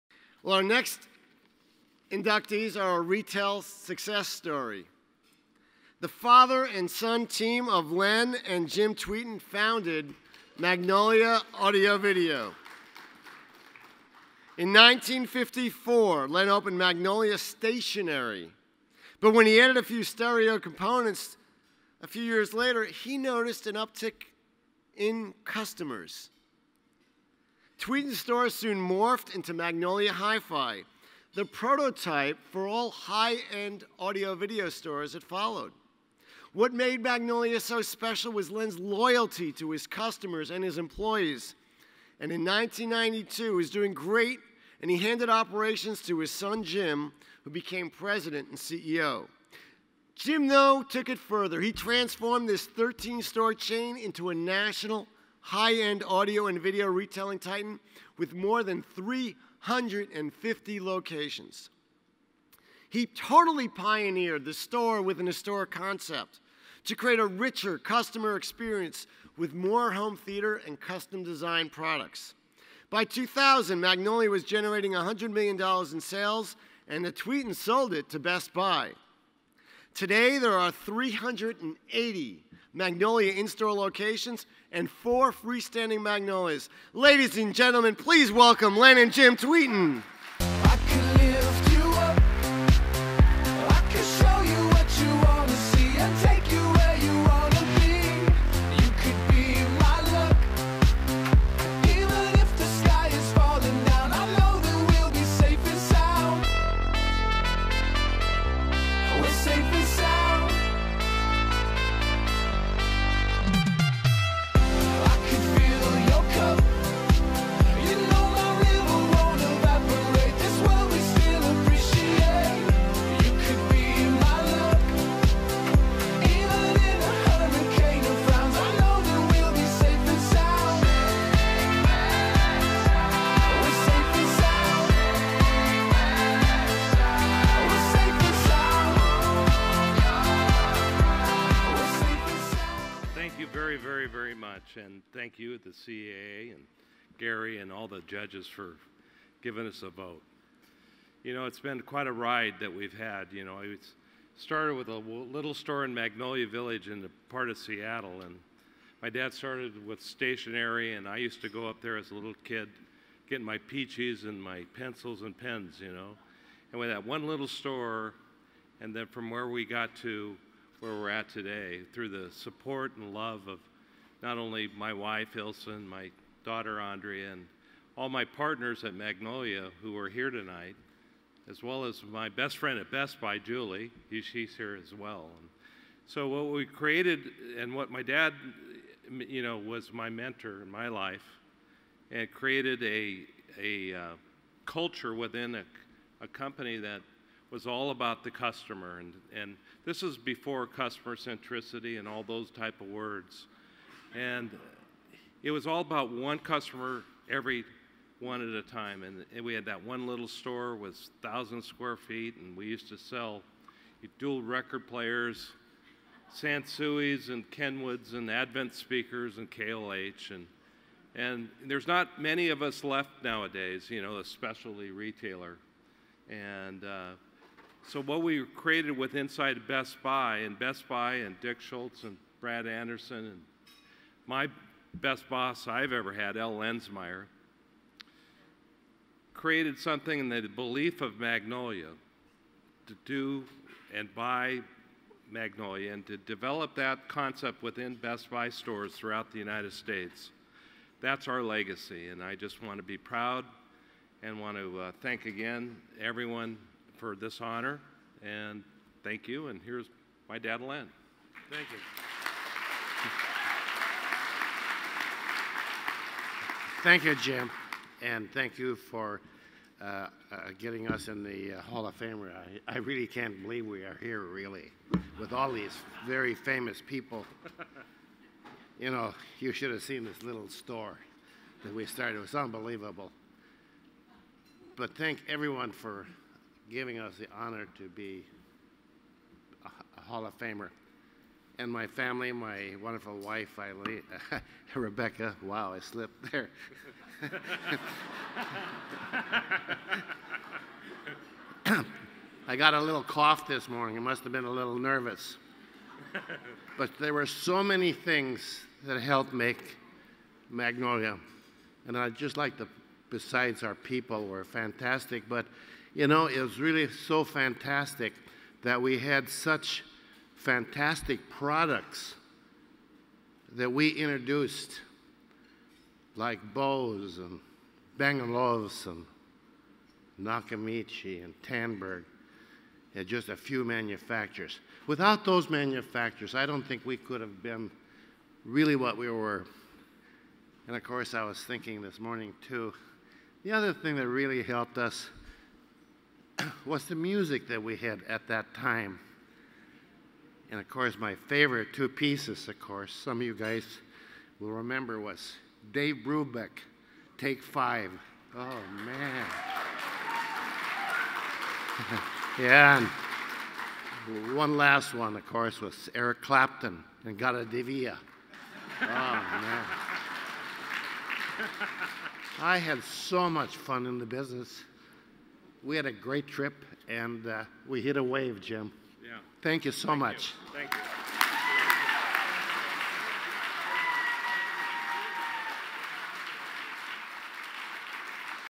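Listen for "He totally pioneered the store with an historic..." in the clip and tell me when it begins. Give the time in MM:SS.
01:02.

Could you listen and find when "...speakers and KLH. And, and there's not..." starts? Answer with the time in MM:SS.
03:38.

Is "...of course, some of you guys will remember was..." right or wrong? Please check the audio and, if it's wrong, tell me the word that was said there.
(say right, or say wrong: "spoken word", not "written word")
right.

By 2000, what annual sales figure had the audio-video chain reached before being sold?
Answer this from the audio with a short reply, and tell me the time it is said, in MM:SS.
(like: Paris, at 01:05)
$100 million, at 01:14.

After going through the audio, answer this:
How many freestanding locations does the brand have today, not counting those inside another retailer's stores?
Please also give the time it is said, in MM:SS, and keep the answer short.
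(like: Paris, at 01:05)
4, at 01:24.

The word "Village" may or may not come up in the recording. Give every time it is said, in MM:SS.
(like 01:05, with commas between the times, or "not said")
02:36.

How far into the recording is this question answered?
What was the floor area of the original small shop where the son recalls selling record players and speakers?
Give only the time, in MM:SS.
03:31.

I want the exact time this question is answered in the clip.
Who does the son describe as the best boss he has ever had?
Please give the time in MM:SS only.
03:56.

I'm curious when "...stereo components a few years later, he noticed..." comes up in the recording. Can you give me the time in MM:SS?
00:20.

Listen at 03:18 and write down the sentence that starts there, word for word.
And, and this is before customer centricity and all those type of words.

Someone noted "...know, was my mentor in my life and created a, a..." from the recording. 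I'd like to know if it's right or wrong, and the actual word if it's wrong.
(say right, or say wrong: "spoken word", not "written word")
right.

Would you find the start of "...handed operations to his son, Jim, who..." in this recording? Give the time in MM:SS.
00:44.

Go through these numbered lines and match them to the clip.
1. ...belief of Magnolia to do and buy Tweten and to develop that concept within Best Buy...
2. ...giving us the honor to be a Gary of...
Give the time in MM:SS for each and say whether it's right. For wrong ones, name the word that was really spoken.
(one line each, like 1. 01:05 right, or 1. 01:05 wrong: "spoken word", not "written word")
1. 04:00 wrong: "Magnolia", not "Tweten"
2. 04:46 wrong: "Hall", not "Gary".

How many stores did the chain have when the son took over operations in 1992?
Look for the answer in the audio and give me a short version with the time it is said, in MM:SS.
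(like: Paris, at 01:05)
13, at 00:52.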